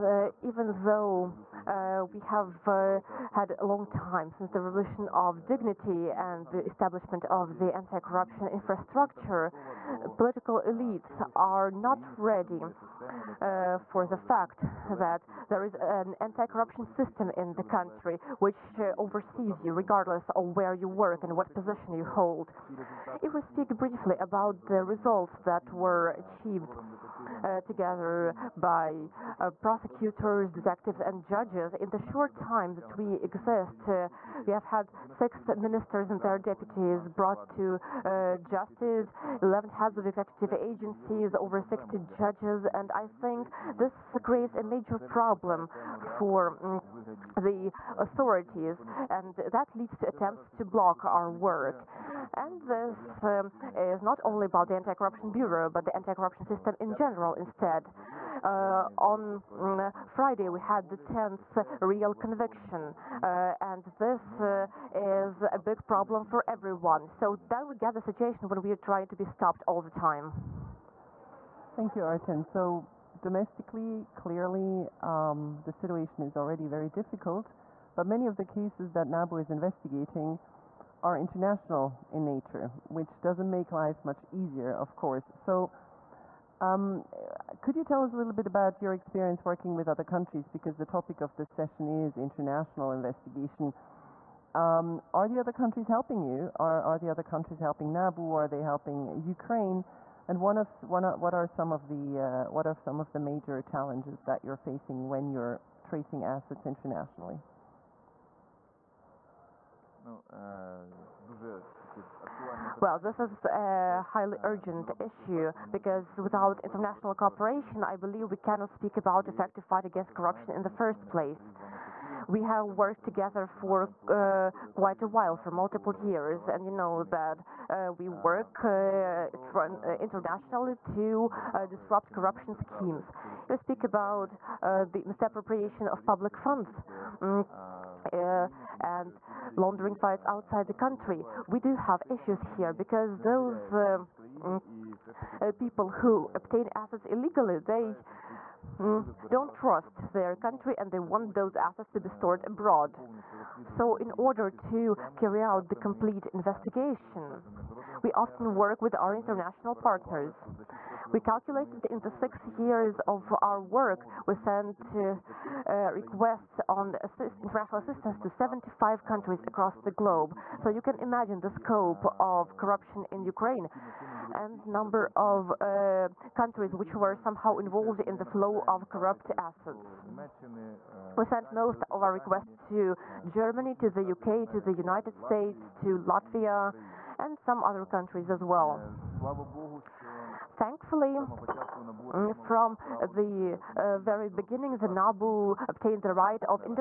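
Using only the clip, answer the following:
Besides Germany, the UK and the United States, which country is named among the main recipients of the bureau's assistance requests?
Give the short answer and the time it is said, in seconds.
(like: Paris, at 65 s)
Latvia, at 185 s.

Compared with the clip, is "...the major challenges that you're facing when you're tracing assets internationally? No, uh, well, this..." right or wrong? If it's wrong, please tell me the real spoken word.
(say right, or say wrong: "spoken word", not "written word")
right.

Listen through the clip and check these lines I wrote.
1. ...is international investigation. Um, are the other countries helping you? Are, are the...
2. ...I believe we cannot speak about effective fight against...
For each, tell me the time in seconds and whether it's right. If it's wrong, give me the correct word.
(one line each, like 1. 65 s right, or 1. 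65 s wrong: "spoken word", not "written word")
1. 91 s right
2. 117 s right.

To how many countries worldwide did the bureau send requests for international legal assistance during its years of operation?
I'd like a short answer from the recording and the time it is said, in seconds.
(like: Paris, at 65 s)
75, at 168 s.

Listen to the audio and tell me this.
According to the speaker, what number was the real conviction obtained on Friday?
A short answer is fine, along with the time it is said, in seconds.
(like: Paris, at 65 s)
10th, at 60 s.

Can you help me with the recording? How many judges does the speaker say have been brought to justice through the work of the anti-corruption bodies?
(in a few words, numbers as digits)
over 60.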